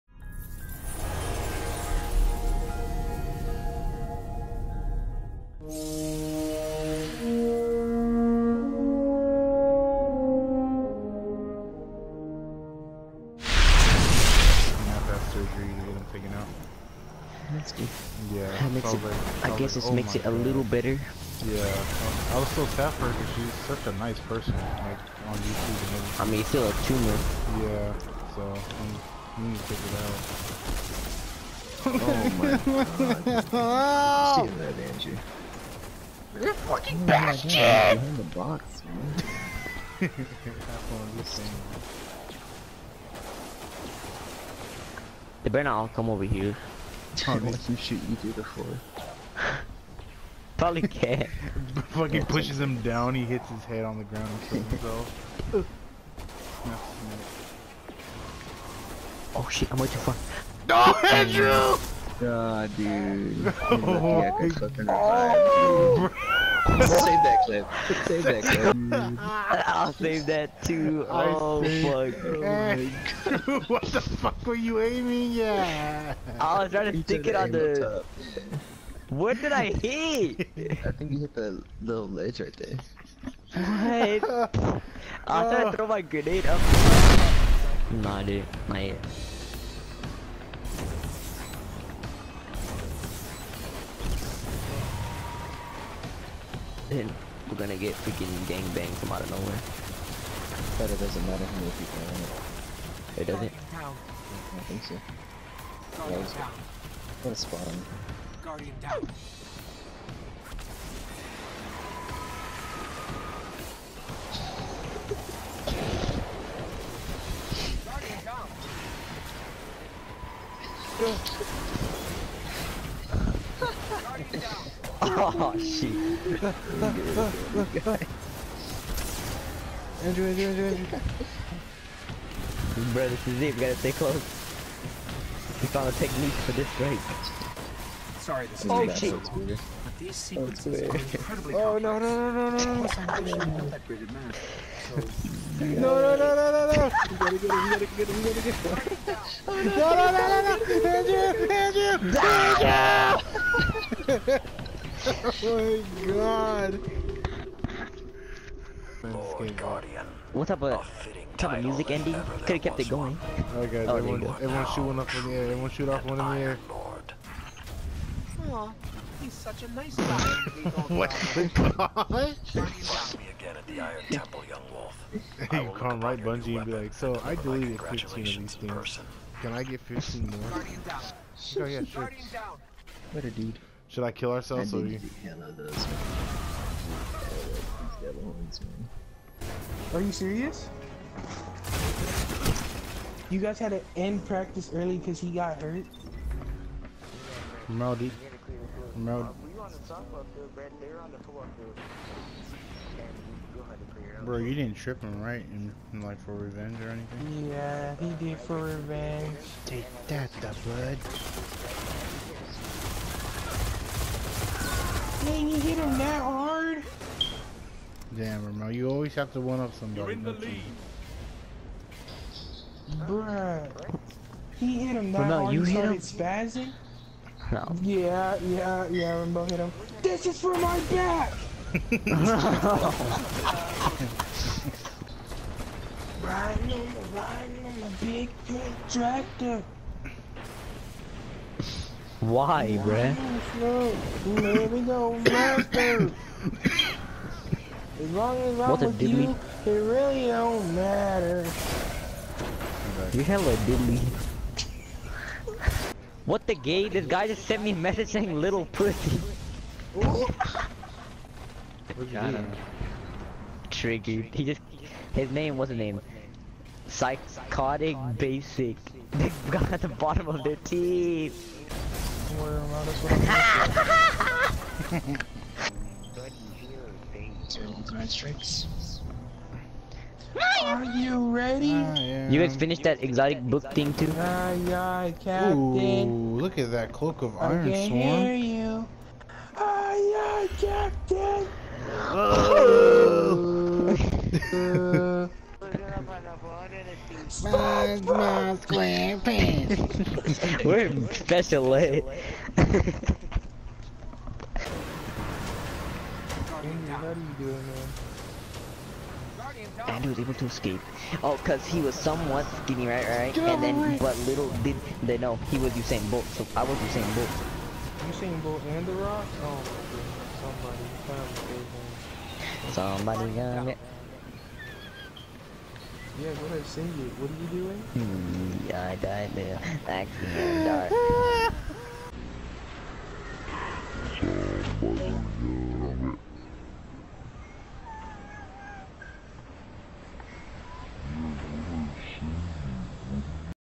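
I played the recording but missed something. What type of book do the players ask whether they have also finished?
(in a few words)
exotic book.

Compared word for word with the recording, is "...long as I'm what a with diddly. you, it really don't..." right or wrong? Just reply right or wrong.
right.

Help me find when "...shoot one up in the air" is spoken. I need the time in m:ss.
2:44.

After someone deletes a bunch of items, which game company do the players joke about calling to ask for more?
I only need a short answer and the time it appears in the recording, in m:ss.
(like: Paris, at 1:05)
Bungie, at 2:56.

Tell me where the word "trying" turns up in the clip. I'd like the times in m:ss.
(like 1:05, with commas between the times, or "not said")
1:16, 1:25.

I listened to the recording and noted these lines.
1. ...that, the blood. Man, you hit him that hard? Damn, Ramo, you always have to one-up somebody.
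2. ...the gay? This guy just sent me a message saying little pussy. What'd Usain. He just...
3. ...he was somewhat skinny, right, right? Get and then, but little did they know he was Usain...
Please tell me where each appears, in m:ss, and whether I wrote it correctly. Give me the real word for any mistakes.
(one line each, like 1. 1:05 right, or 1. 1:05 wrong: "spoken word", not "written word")
1. 3:30 right
2. 4:16 wrong: "Tricky", not "Usain"
3. 5:11 right.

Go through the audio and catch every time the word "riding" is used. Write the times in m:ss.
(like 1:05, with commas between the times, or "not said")
3:51, 3:56.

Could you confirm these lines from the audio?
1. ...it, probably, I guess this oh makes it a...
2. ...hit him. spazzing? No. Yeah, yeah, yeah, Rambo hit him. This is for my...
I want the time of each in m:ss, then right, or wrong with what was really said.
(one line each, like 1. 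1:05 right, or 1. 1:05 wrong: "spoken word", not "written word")
1. 0:19 right
2. 3:45 right.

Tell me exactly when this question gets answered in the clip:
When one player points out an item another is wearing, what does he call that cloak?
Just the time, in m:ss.
4:46.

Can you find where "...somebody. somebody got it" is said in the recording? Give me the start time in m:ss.
5:23.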